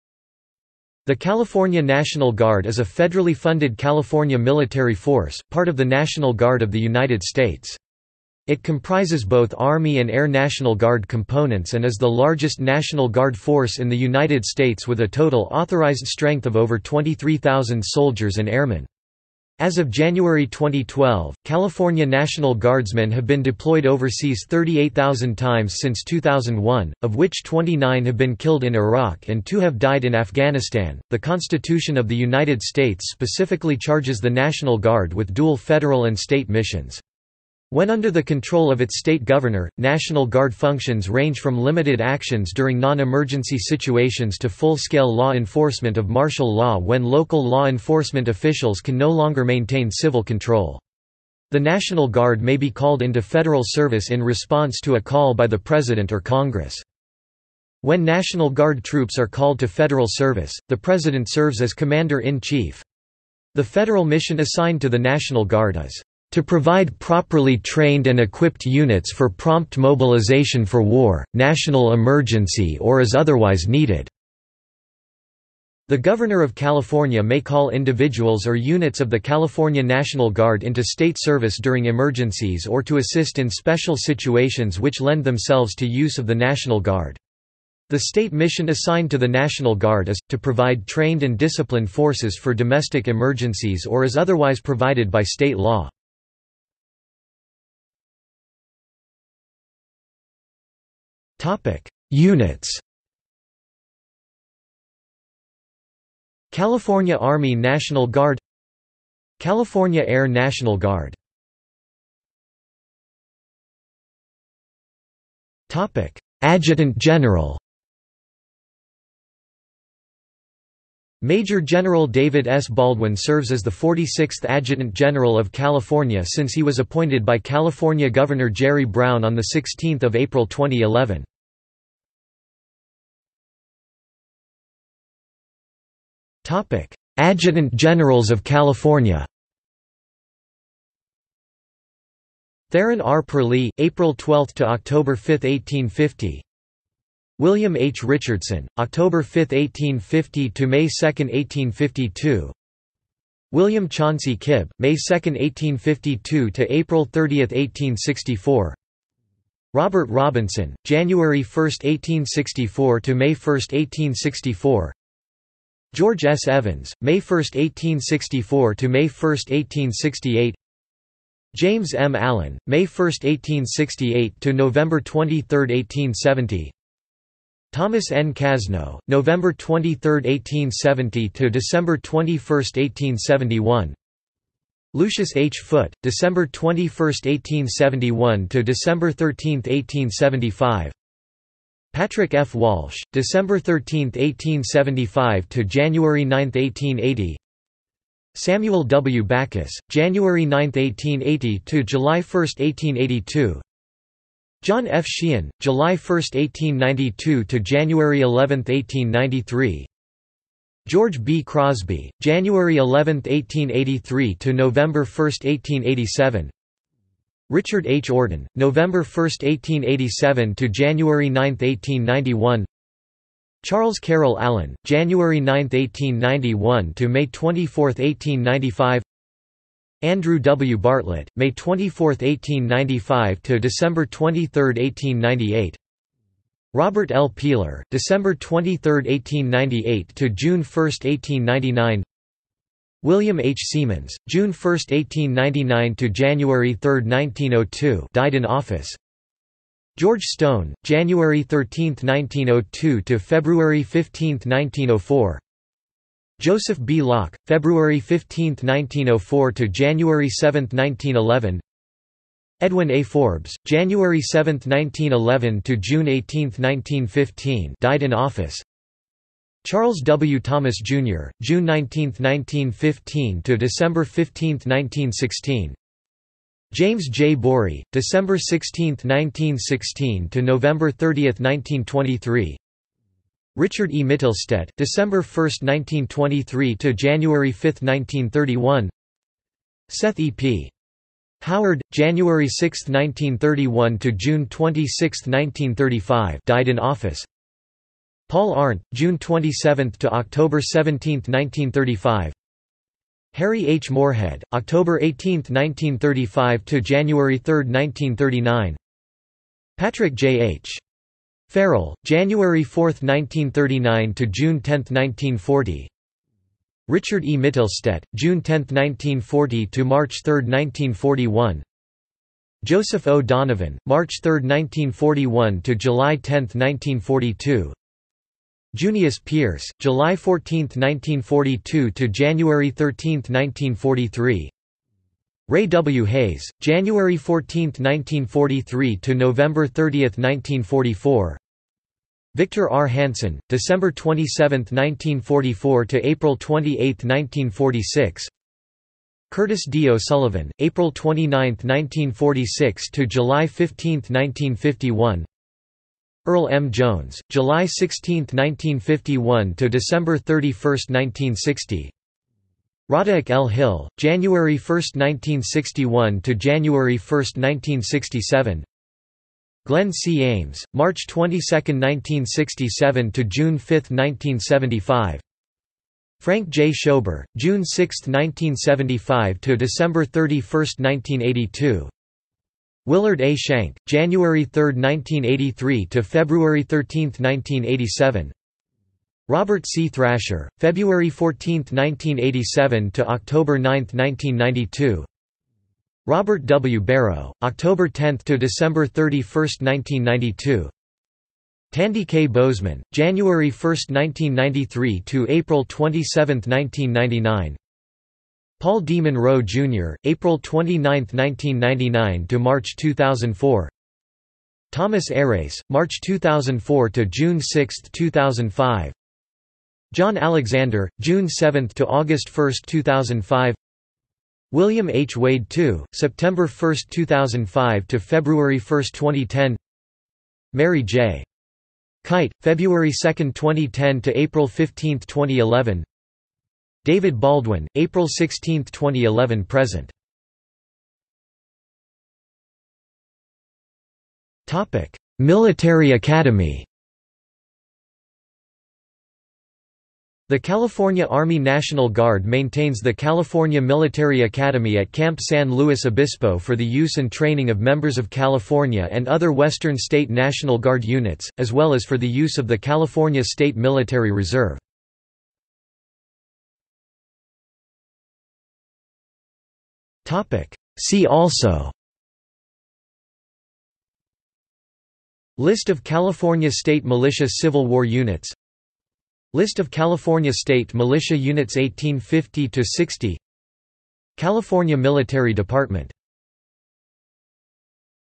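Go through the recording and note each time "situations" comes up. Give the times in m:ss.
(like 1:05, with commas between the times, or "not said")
0:43, 1:23.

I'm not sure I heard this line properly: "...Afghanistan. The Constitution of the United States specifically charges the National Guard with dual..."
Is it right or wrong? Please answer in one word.
right.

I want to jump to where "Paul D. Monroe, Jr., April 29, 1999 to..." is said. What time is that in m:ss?
6:48.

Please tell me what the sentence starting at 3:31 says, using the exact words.
Crosby, January 11, 1883 to November 1, 1887.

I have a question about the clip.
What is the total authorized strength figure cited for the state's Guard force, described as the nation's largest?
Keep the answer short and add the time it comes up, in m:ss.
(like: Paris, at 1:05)
over 23,000, at 0:16.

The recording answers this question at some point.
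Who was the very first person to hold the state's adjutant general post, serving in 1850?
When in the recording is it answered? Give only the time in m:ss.
2:22.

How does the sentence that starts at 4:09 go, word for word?
George Stone, January 13, 1902 to February 15, 1904.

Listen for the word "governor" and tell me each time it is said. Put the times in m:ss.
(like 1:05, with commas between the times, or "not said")
0:39, 1:15, 2:08.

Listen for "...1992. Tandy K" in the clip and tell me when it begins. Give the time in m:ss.
6:39.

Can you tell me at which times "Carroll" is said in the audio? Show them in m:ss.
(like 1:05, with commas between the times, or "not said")
3:43.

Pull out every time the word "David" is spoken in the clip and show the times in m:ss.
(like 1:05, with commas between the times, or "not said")
2:02, 7:16.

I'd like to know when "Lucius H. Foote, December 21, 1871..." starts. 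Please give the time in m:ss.
3:04.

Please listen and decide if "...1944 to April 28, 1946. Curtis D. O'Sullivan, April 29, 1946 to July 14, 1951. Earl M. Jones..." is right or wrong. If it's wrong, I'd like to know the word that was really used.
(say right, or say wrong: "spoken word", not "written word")
wrong: "15", not "14".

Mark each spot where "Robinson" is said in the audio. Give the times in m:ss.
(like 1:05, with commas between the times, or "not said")
2:40.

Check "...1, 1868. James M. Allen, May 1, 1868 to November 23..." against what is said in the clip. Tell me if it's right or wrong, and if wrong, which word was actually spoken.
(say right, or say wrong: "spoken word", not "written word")
right.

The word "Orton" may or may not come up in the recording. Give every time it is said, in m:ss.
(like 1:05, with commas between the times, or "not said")
3:38.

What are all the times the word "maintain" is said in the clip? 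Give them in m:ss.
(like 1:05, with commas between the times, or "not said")
0:49, 7:32.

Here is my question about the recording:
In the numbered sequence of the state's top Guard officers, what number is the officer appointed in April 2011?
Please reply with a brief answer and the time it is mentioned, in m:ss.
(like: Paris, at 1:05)
46th, at 2:03.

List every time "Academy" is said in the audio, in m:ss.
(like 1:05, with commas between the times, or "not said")
7:25, 7:34.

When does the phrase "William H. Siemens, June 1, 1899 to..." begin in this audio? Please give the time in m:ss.
4:03.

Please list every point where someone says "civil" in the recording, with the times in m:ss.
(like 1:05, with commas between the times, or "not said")
0:49, 7:57.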